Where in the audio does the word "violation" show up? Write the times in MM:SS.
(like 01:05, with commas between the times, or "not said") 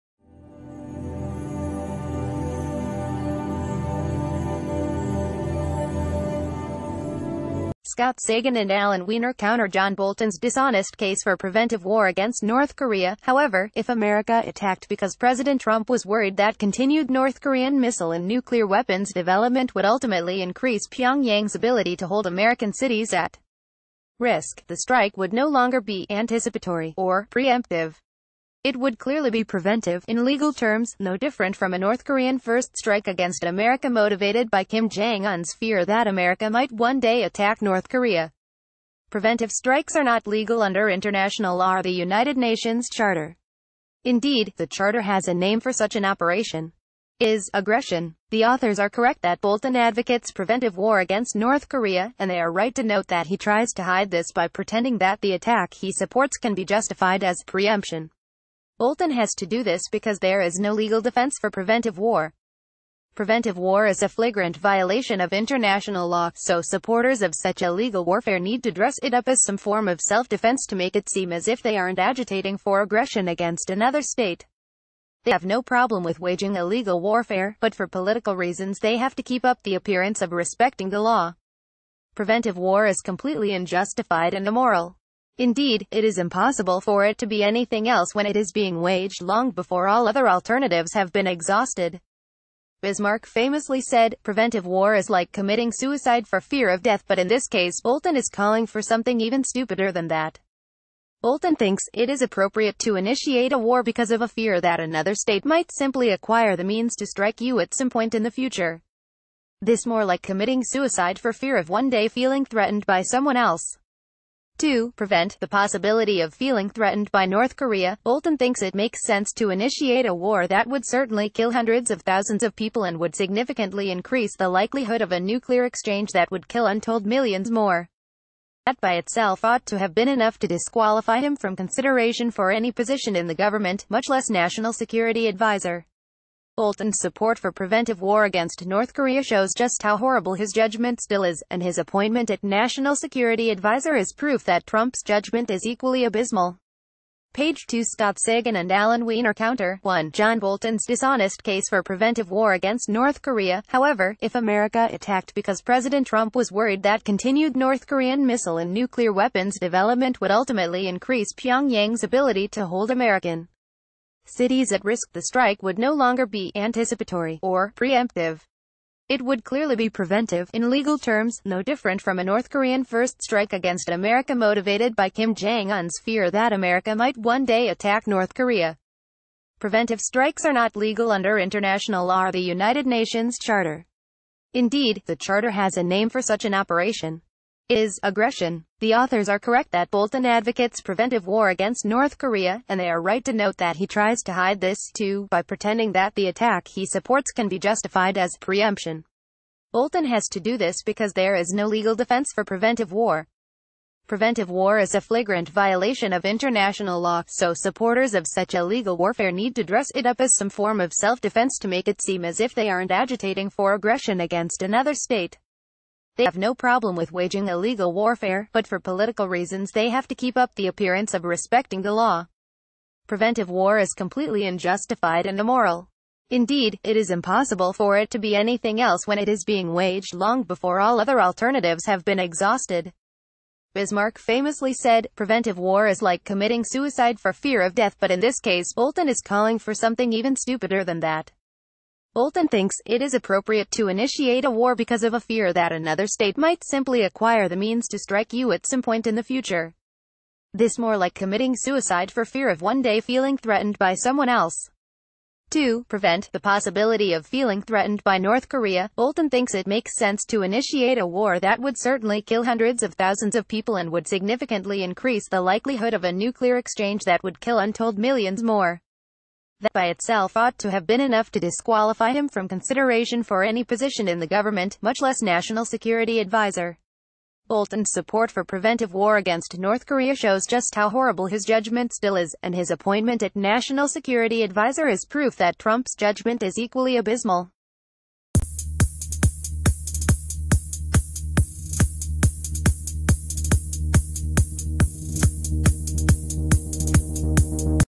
01:04, 03:25.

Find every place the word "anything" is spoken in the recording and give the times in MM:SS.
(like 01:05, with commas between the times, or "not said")
01:27, 03:48.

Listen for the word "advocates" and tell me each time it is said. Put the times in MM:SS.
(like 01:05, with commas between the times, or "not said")
00:49, 03:10.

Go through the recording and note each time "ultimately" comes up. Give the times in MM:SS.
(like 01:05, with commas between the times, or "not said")
00:19, 02:40.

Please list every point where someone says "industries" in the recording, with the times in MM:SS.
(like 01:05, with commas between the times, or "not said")
not said.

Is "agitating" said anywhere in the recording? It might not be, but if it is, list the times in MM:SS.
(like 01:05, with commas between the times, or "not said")
01:11, 03:32.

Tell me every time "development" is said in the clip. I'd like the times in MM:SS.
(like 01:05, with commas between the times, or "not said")
00:19, 02:39.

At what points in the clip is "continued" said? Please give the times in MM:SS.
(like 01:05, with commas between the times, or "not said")
00:16, 02:37.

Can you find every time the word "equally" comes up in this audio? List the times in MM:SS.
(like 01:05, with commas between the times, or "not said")
02:25, 04:46.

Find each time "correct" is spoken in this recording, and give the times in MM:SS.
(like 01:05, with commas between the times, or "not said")
00:48, 03:09.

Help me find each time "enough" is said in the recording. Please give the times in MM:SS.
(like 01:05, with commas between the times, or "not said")
02:10, 04:31.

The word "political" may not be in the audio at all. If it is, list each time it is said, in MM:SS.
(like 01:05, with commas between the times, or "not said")
01:17, 03:38.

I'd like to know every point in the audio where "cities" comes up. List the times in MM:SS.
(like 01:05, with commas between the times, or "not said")
00:22, 02:44.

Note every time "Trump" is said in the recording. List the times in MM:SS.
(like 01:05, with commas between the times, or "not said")
00:15, 02:24, 02:36, 04:45.